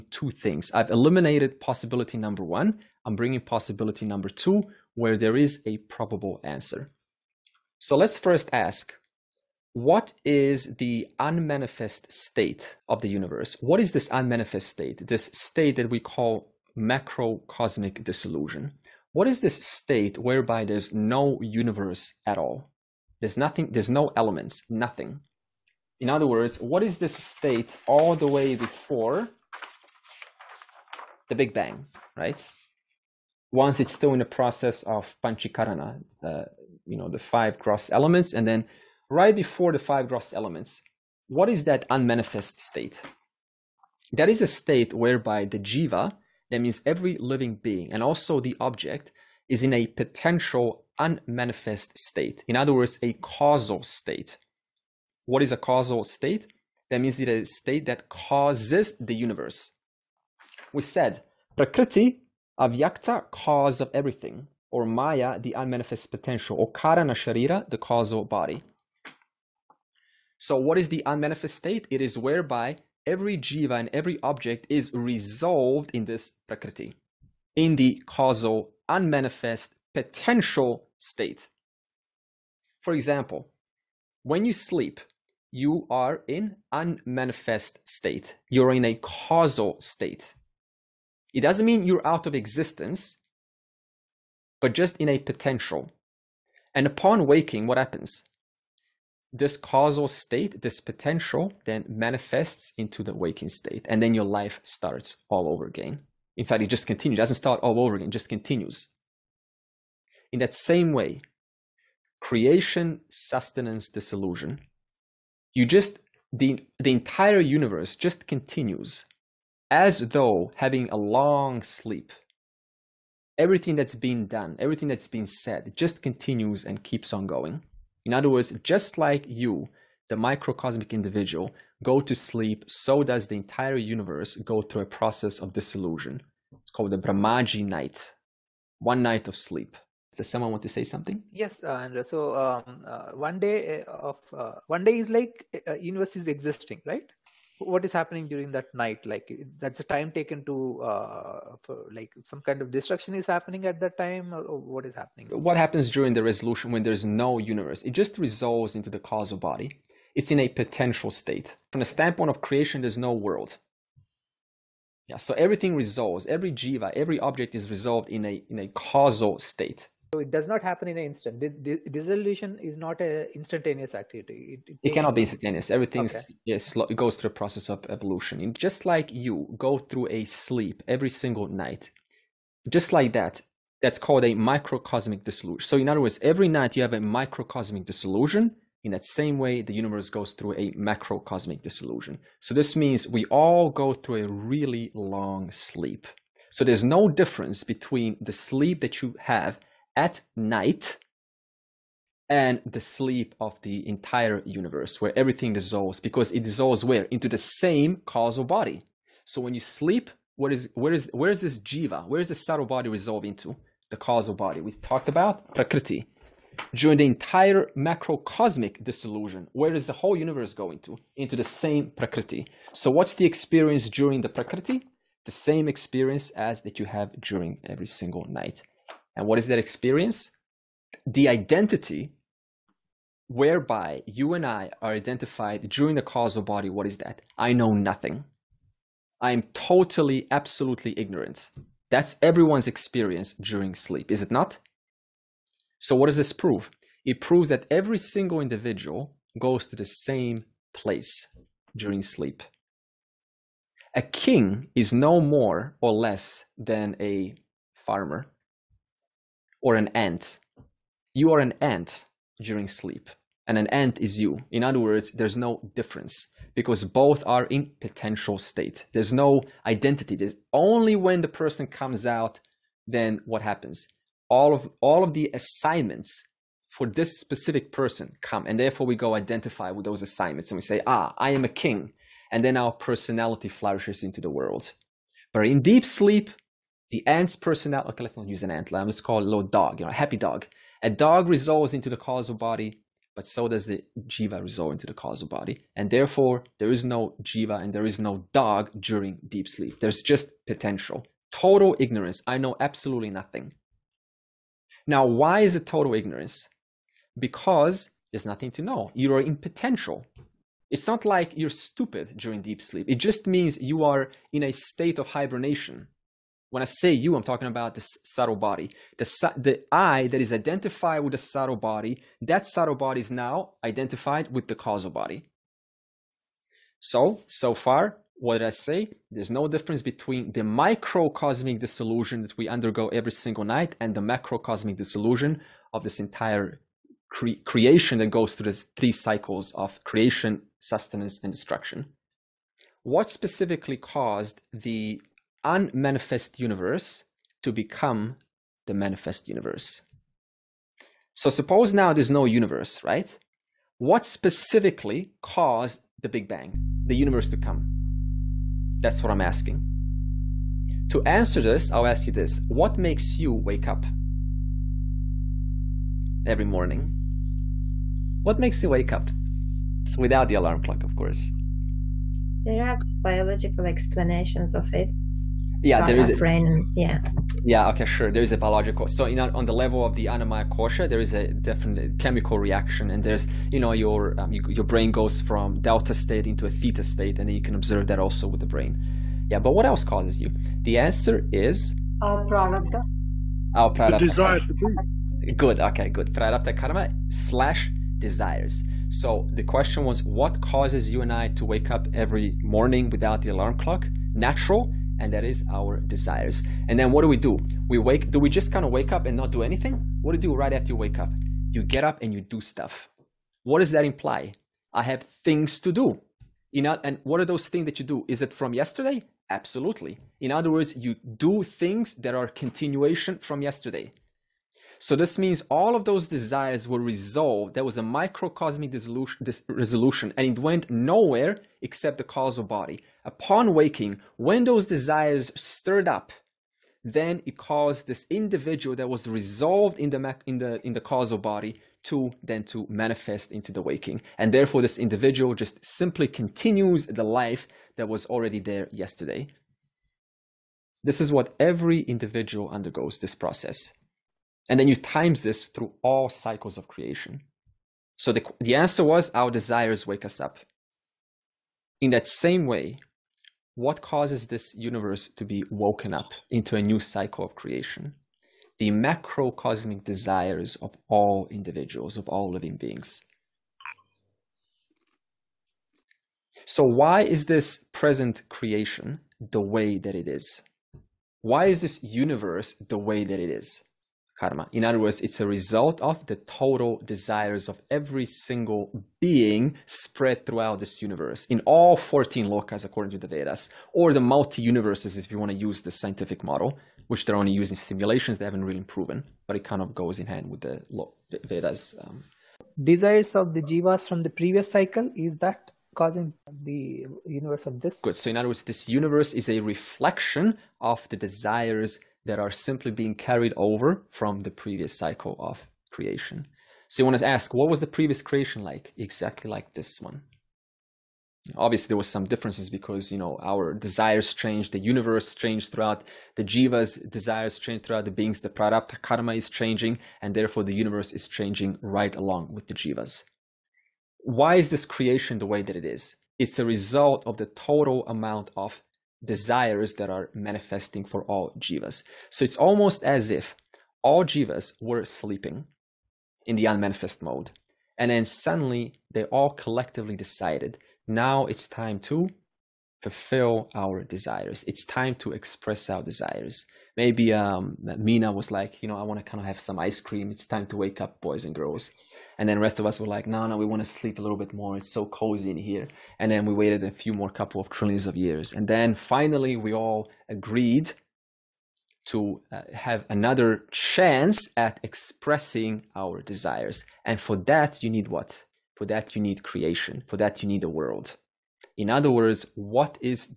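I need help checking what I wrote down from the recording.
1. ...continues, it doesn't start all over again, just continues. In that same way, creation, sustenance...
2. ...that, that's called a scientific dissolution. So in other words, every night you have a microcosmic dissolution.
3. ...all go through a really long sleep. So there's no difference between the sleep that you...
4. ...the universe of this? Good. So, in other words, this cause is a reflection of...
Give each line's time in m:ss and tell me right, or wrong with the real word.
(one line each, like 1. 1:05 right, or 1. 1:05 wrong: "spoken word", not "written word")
1. 1:46 right
2. 3:03 wrong: "microcosmic", not "scientific"
3. 3:13 right
4. 8:26 wrong: "universe", not "cause".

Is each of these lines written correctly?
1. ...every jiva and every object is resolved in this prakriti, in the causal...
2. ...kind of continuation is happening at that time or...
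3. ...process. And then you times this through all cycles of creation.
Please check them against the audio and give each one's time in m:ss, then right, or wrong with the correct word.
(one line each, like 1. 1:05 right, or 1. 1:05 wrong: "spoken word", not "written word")
1. 1:13 right
2. 2:32 wrong: "destruction", not "continuation"
3. 7:33 right.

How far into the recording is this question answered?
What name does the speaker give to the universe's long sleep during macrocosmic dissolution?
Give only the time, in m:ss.
2:16.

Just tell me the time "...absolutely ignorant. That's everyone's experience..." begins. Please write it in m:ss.
4:00.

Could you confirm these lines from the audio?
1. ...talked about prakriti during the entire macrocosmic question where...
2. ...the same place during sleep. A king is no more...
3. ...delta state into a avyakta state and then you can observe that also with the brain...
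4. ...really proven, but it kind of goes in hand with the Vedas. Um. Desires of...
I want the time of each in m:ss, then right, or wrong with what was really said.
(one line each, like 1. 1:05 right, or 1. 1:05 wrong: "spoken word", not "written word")
1. 3:34 wrong: "dissolution", not "question"
2. 4:09 right
3. 6:25 wrong: "theta", not "avyakta"
4. 8:18 right.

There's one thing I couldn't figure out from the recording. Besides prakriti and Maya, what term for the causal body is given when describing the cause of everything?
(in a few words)
Karana Sharira.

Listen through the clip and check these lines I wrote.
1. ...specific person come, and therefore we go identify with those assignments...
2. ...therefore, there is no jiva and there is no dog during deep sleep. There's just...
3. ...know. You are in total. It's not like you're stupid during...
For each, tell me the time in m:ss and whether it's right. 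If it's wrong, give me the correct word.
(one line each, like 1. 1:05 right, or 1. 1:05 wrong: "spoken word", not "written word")
1. 4:37 right
2. 4:55 right
3. 5:08 wrong: "potential", not "total".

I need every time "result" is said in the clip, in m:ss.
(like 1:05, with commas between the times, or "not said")
8:05, 8:56.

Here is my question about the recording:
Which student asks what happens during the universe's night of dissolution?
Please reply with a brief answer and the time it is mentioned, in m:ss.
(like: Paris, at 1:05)
Andra, at 2:21.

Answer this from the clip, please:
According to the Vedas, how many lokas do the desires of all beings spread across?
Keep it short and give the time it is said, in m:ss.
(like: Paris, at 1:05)
14, at 8:11.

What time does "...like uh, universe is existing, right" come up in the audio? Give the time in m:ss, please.
2:25.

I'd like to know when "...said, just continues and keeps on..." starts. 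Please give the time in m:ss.
2:05.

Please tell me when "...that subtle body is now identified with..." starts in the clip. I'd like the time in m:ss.
5:22.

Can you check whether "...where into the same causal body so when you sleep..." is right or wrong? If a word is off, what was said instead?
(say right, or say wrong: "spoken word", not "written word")
right.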